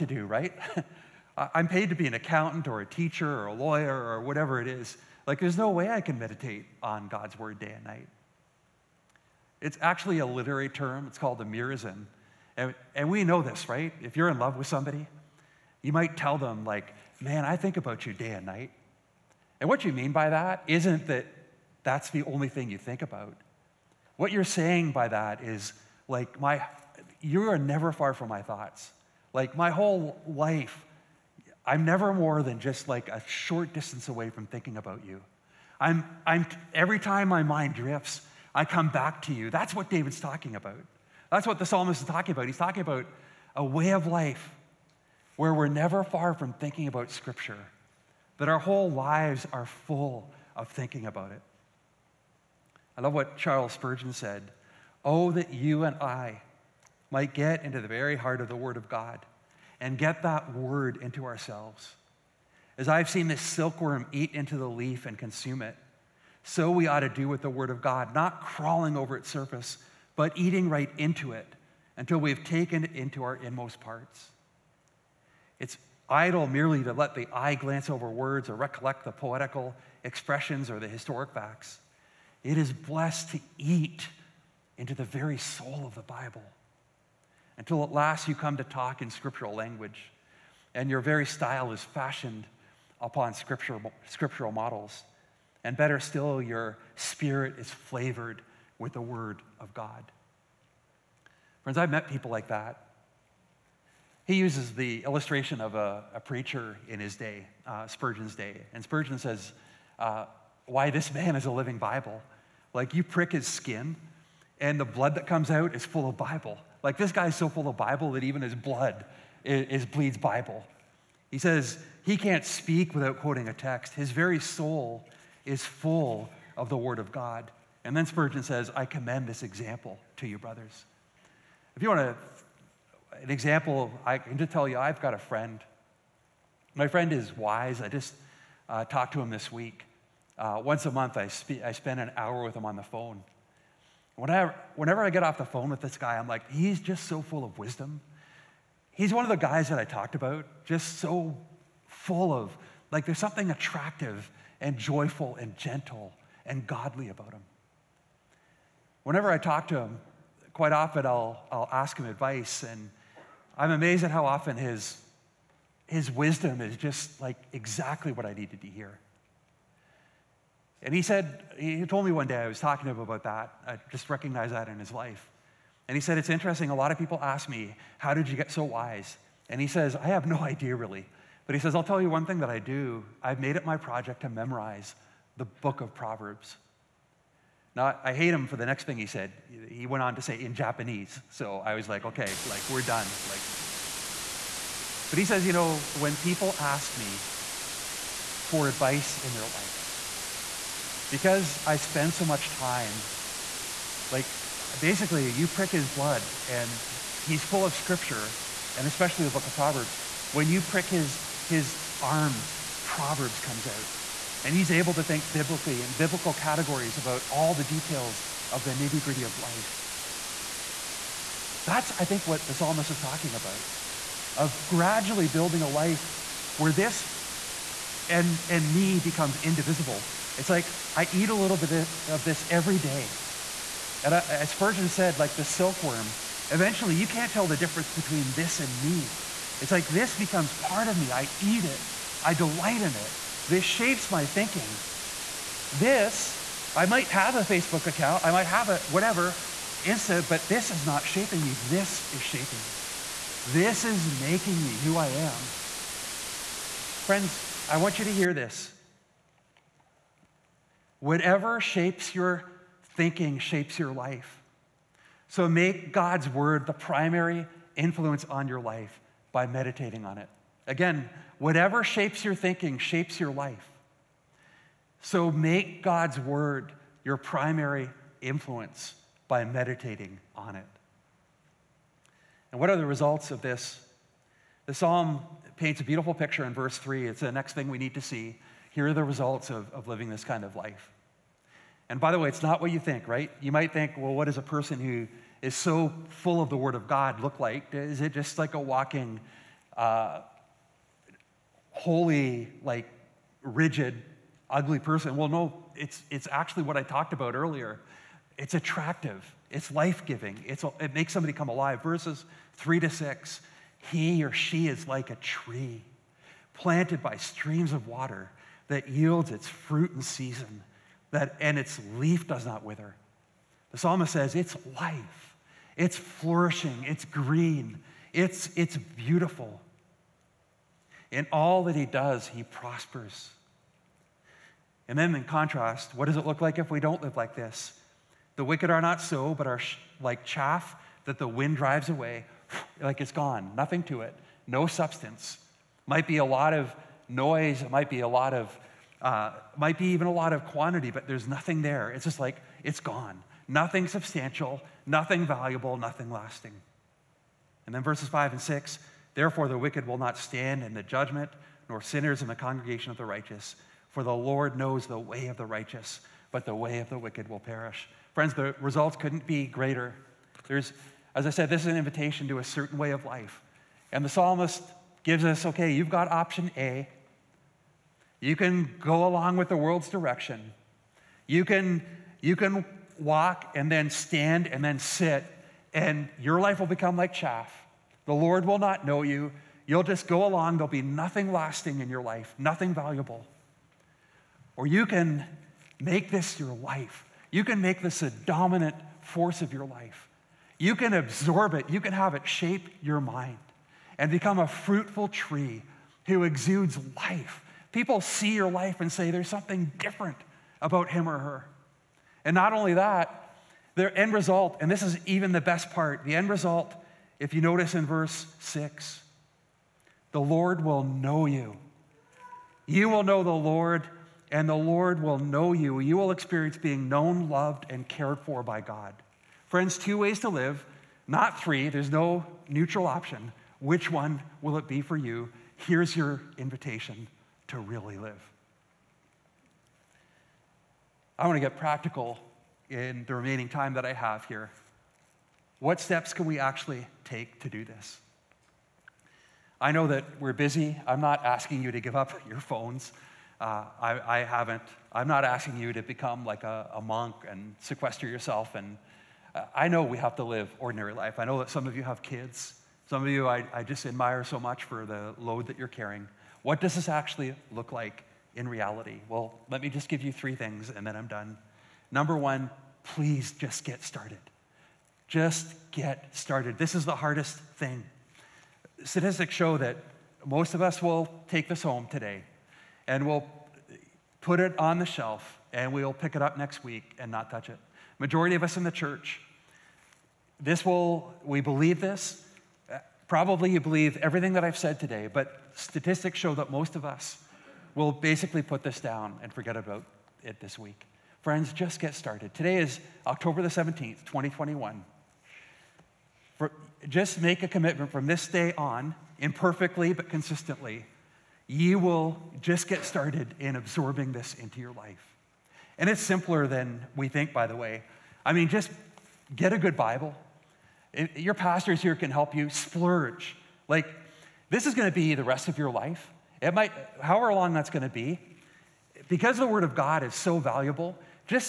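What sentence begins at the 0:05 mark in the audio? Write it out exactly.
Like, there's no way I can meditate on God's word day and night.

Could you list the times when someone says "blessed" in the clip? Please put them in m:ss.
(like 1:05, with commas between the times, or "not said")
1:22.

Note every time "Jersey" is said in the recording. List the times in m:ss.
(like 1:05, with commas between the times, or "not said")
not said.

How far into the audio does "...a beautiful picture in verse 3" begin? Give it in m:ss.
4:45.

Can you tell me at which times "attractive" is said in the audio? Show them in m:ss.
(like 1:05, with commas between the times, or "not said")
2:33, 5:08.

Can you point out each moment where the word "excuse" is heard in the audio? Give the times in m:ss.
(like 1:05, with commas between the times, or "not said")
not said.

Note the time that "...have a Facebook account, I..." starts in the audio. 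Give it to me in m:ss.
4:07.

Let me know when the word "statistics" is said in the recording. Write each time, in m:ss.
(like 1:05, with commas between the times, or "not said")
7:58, 8:15.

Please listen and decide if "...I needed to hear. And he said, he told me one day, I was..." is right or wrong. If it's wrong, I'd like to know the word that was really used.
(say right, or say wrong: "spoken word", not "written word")
right.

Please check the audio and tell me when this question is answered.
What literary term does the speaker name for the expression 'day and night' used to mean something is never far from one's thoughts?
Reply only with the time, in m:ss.
0:11.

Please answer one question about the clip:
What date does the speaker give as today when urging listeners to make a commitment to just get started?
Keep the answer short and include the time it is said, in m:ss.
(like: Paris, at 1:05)
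October 17, 2021, at 8:23.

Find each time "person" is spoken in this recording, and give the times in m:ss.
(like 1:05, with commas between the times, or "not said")
4:54, 5:04.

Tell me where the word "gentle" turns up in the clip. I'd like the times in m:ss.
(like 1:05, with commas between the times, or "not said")
2:35.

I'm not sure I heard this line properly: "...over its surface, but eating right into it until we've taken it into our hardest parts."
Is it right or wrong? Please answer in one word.
wrong.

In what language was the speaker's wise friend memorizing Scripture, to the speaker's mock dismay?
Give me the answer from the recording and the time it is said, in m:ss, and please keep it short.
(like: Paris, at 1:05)
Japanese, at 3:10.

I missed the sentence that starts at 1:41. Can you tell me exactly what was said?
Friends, I've met people like that.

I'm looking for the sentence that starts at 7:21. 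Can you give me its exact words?
I want to get practical in the remaining time that I have here.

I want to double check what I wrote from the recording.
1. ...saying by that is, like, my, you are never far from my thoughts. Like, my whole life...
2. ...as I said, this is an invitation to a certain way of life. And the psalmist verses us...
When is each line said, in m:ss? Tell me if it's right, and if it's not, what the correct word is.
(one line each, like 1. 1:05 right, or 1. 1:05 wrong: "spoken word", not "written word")
1. 0:24 right
2. 6:11 wrong: "gives", not "verses".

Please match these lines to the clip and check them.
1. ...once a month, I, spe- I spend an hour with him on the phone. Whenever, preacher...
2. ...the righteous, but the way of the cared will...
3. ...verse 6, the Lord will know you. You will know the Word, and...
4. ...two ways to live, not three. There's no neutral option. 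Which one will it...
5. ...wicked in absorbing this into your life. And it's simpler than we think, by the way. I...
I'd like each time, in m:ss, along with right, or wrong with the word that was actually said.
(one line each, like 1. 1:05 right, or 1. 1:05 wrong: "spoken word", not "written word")
1. 2:20 wrong: "whenever", not "preacher"
2. 6:05 wrong: "wicked", not "cared"
3. 6:57 wrong: "Lord", not "Word"
4. 7:09 right
5. 8:32 wrong: "started", not "wicked".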